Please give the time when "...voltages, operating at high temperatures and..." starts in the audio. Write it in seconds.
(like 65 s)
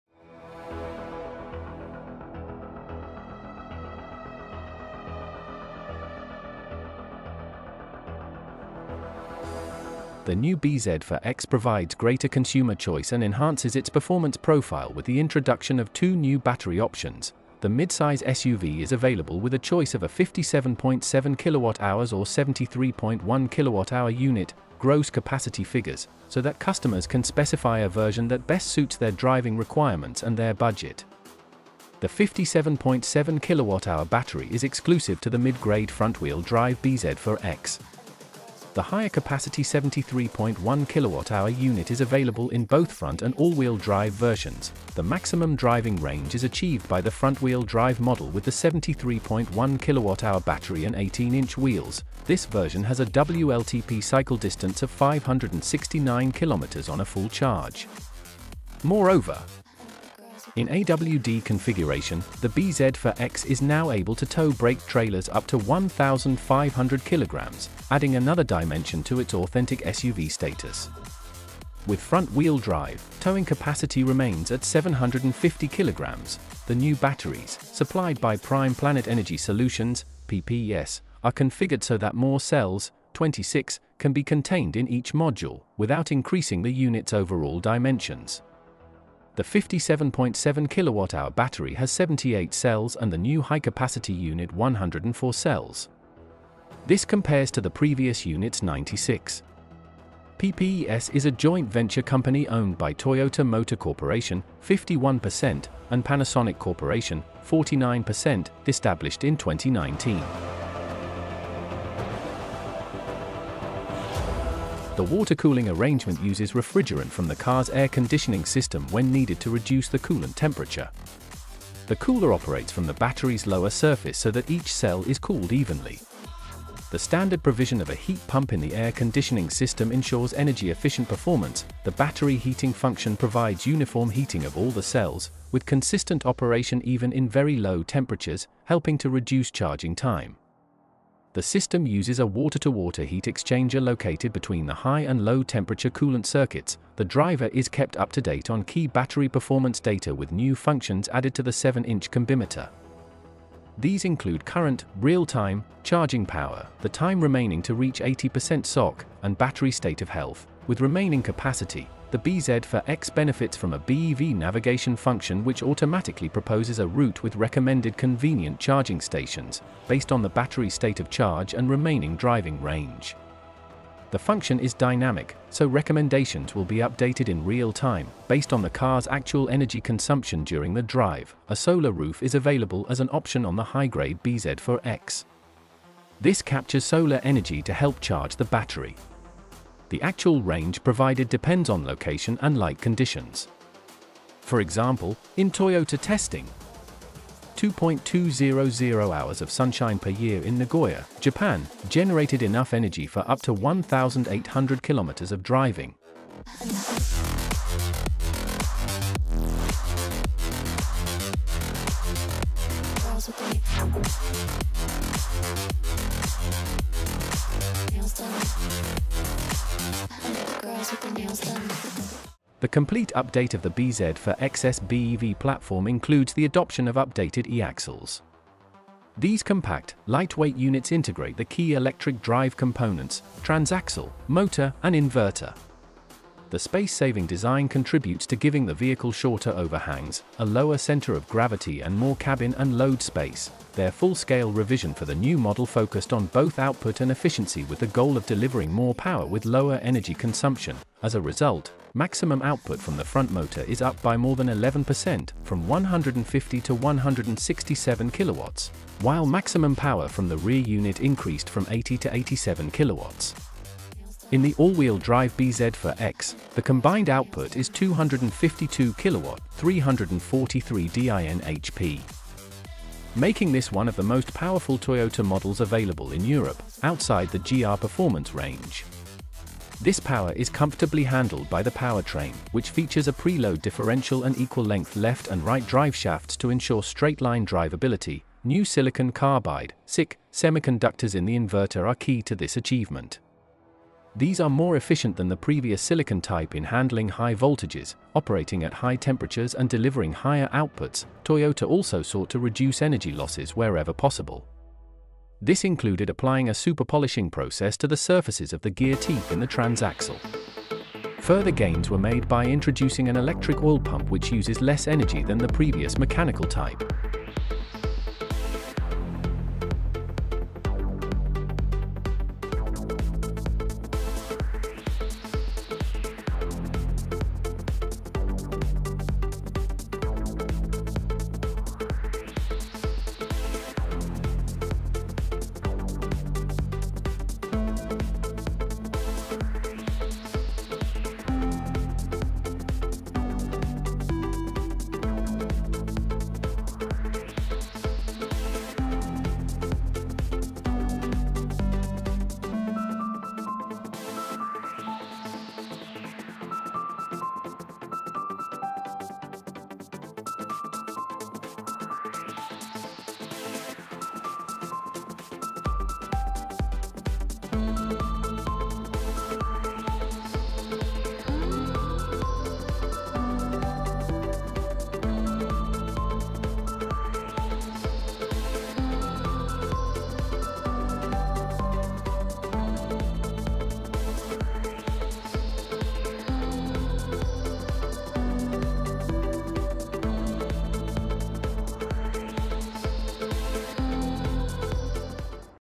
297 s.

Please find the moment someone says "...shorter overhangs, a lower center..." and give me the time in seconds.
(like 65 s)
239 s.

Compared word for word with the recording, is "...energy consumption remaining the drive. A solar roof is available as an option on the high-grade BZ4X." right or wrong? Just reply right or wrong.
wrong.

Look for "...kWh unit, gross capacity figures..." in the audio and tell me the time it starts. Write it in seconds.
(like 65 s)
23 s.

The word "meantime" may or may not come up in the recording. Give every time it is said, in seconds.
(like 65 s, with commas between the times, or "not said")
not said.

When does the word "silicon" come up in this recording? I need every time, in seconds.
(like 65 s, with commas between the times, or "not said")
288 s, 295 s.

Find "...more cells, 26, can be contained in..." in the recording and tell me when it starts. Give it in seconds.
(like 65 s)
82 s.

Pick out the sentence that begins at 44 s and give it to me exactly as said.
The maximum driving range is achieved by the front-wheel drive model with the 73.1 kWh battery and 18-inch wheels.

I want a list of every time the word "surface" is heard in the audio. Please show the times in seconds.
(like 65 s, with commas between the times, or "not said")
123 s, 307 s.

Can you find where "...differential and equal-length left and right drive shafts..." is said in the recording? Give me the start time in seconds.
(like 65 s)
283 s.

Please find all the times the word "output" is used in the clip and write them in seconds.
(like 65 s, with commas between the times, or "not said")
246 s, 252 s, 267 s, 300 s.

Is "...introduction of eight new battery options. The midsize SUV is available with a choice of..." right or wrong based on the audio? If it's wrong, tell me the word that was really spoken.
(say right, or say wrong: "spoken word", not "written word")
wrong: "two", not "eight".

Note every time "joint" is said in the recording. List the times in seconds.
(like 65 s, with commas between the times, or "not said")
101 s.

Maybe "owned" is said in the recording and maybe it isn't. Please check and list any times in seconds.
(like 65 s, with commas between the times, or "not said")
102 s.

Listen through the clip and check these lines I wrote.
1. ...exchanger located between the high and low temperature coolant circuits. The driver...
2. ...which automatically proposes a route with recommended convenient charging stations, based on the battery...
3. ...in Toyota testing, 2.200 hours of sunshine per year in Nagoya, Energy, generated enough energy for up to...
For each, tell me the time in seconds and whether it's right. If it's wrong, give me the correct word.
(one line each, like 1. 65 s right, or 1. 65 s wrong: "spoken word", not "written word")
1. 143 s right
2. 165 s right
3. 195 s wrong: "Japan", not "Energy".